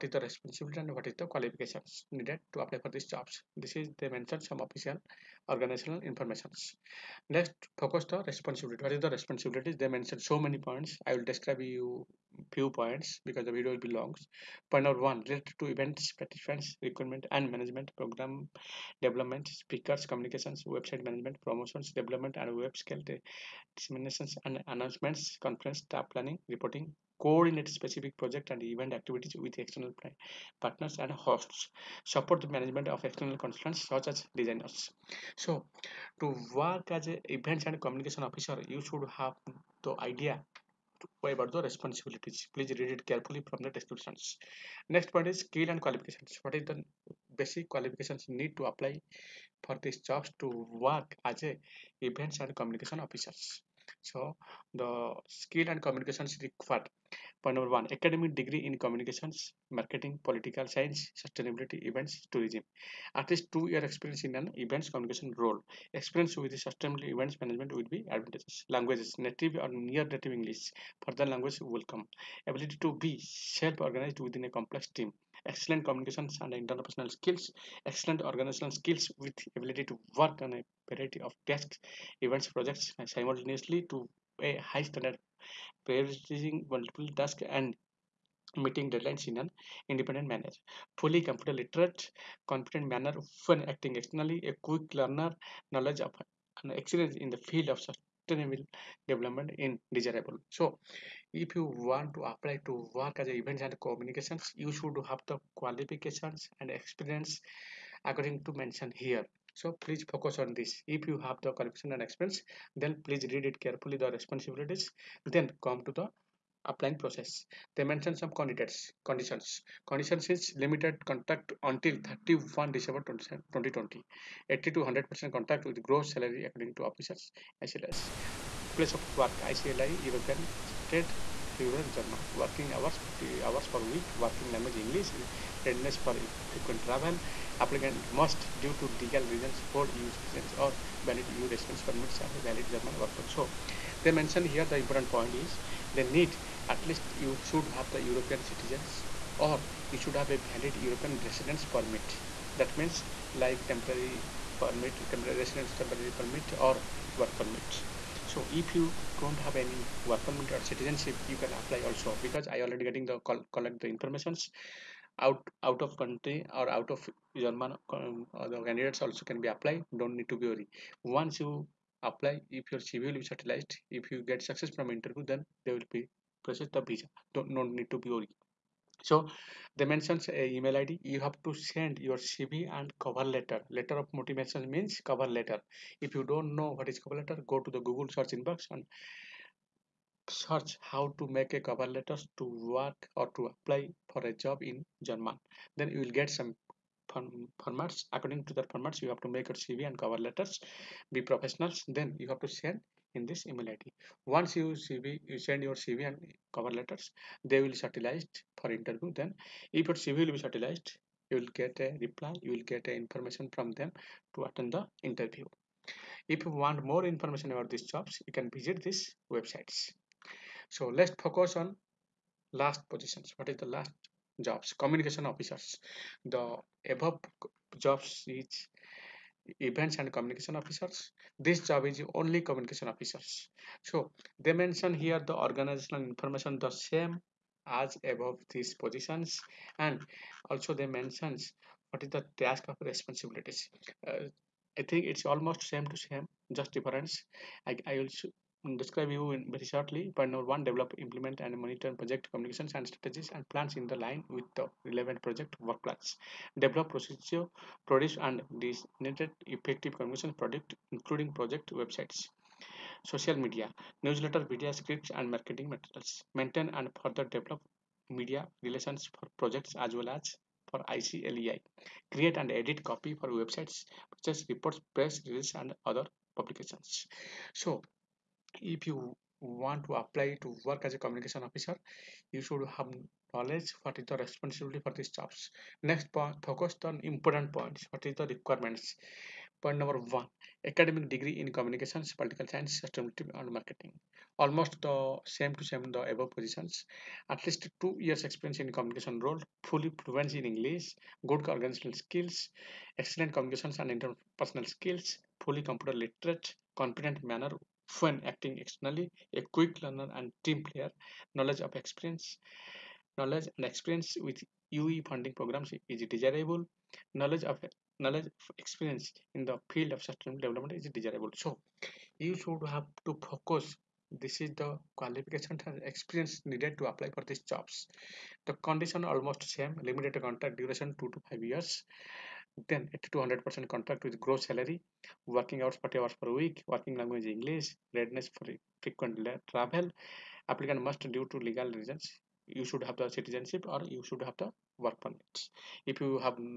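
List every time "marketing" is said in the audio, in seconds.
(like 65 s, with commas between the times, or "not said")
59 s, 265 s, 293 s.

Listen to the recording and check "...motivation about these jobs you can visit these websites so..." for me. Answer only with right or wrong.
wrong.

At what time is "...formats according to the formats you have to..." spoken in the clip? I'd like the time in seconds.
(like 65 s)
197 s.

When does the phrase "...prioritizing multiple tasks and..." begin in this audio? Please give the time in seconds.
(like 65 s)
85 s.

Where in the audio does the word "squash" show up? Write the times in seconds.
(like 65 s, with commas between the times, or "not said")
not said.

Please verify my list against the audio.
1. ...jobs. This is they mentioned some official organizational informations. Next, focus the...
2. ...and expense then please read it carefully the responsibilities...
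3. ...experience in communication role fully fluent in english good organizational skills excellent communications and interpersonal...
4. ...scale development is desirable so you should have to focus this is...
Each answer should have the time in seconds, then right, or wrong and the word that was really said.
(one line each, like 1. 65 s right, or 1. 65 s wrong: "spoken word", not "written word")
1. 3 s right
2. 111 s right
3. 298 s right
4. 320 s wrong: "sustainable", not "scale".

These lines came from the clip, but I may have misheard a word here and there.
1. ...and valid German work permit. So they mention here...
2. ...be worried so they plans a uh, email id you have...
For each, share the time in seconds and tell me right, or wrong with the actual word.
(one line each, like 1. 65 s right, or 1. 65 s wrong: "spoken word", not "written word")
1. 142 s right
2. 177 s wrong: "mentions", not "plans".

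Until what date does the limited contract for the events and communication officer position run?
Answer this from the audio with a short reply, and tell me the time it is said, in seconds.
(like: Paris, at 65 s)
31 December 2020, at 122 s.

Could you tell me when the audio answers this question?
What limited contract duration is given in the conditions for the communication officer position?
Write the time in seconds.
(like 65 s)
330 s.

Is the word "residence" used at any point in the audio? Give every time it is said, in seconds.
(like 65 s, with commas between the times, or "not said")
141 s, 151 s, 155 s.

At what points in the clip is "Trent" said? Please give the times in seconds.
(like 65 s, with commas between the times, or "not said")
not said.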